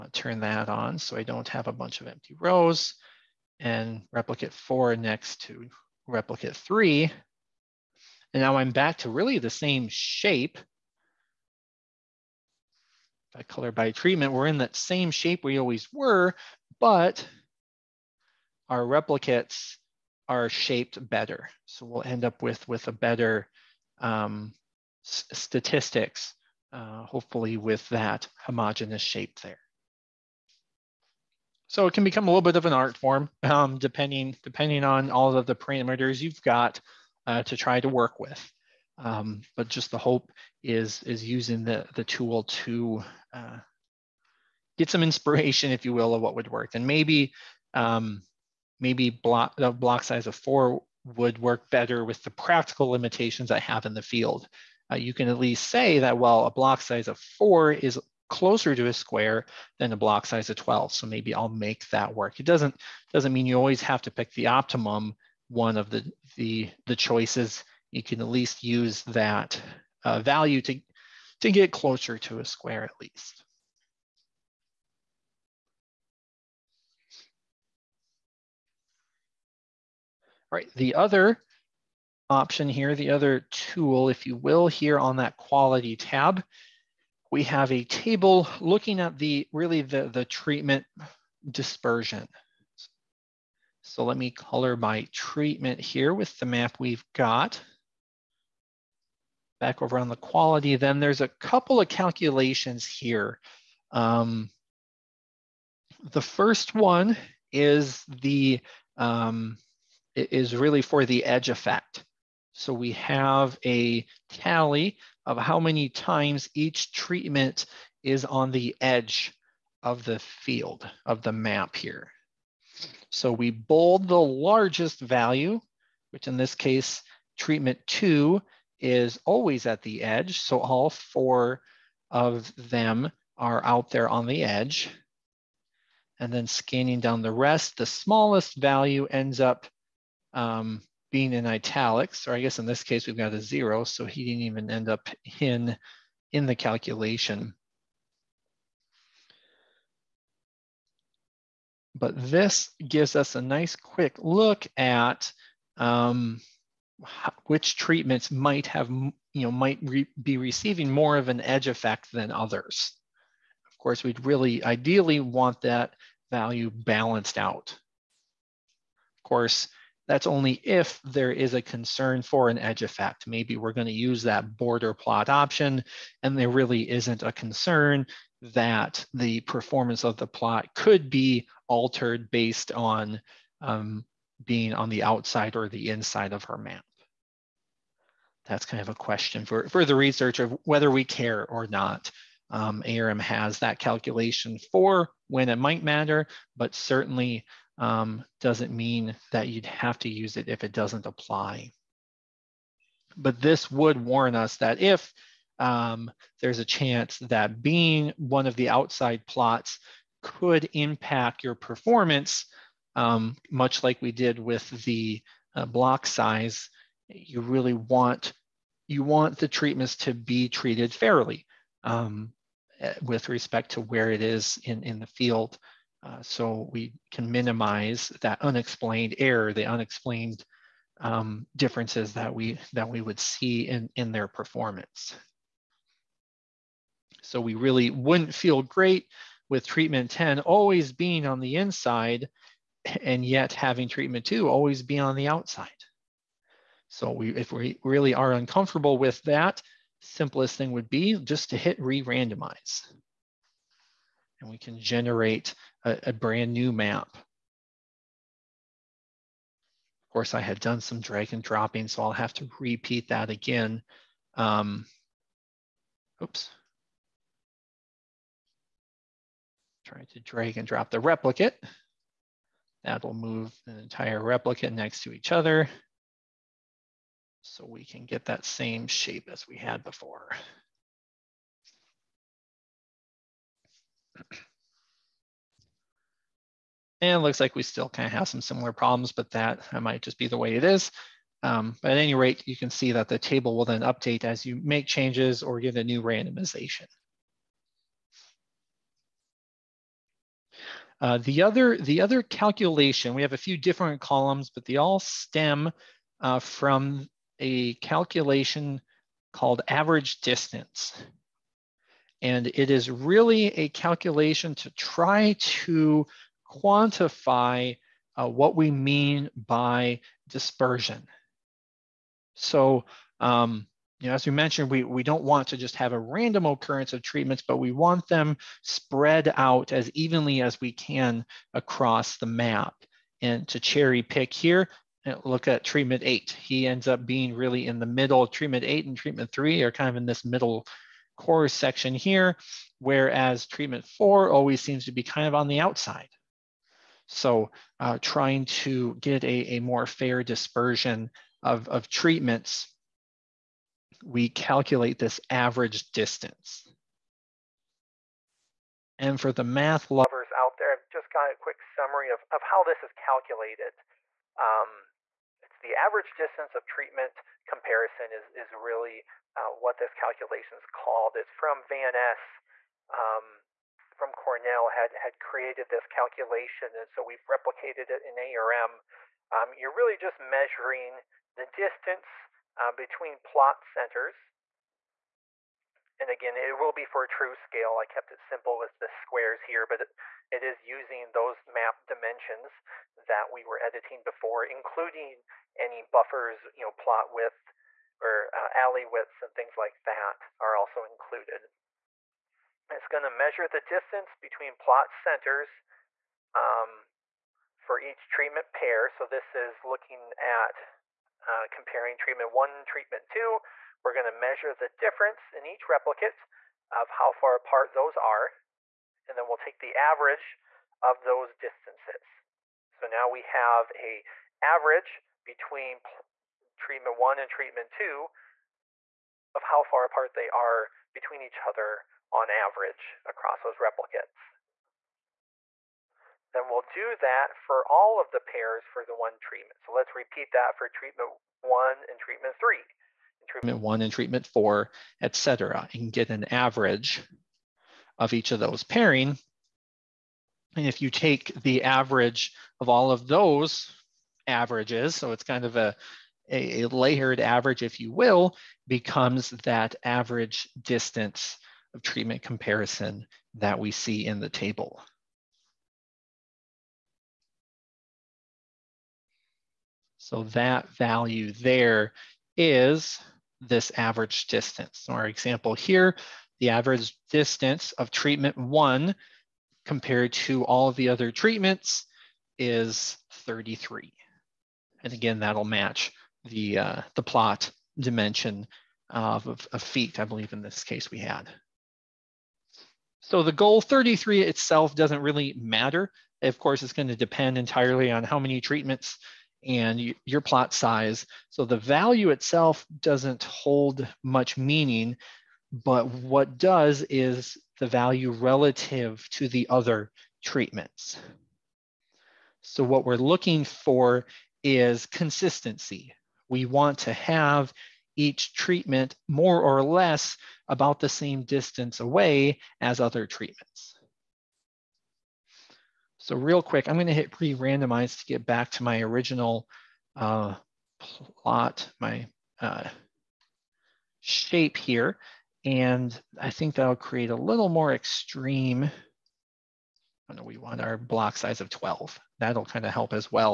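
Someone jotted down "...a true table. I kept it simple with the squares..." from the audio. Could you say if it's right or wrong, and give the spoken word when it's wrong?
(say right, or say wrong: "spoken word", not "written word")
wrong: "scale", not "table".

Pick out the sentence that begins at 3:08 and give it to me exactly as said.
That's kind of a question for, for the research of whether we care or not.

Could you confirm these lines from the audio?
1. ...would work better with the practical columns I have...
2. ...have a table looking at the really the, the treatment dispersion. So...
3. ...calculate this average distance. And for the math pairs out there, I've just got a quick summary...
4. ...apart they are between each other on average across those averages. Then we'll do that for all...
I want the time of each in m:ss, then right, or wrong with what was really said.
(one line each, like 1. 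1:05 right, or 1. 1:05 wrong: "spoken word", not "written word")
1. 0:51 wrong: "limitations", not "columns"
2. 1:27 right
3. 5:54 wrong: "lovers", not "pairs"
4. 7:09 wrong: "replicates", not "averages".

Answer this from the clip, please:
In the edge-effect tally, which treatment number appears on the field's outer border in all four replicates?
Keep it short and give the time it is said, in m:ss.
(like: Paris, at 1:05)
2, at 2:07.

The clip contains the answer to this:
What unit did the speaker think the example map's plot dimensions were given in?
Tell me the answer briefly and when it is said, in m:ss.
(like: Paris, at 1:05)
Feet, at 8:09.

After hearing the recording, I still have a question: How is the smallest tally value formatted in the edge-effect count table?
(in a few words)
Italics.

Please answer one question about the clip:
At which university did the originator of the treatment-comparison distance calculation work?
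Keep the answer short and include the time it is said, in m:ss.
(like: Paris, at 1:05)
Cornell, at 6:14.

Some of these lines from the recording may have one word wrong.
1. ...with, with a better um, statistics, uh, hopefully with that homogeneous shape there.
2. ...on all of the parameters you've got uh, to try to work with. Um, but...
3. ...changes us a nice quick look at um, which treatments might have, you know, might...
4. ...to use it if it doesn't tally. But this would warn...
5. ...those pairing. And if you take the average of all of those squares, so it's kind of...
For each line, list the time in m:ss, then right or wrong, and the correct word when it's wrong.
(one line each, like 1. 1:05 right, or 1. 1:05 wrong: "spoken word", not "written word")
1. 0:22 right
2. 0:34 right
3. 2:32 wrong: "gives", not "changes"
4. 3:19 wrong: "apply", not "tally"
5. 7:28 wrong: "averages", not "squares".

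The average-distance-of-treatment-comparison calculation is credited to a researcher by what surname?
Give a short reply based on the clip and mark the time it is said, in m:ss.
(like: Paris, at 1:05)
Van Es, at 6:11.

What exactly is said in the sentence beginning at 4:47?
and looks like we still kind of have some similar problems, but that might just be the way it is.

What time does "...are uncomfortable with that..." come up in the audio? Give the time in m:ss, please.
4:08.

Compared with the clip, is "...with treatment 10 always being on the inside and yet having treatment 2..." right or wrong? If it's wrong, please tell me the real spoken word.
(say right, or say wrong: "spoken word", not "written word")
right.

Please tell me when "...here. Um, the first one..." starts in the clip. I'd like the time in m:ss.
1:42.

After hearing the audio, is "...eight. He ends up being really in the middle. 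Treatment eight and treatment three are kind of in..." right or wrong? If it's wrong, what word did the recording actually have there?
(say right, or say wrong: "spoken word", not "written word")
right.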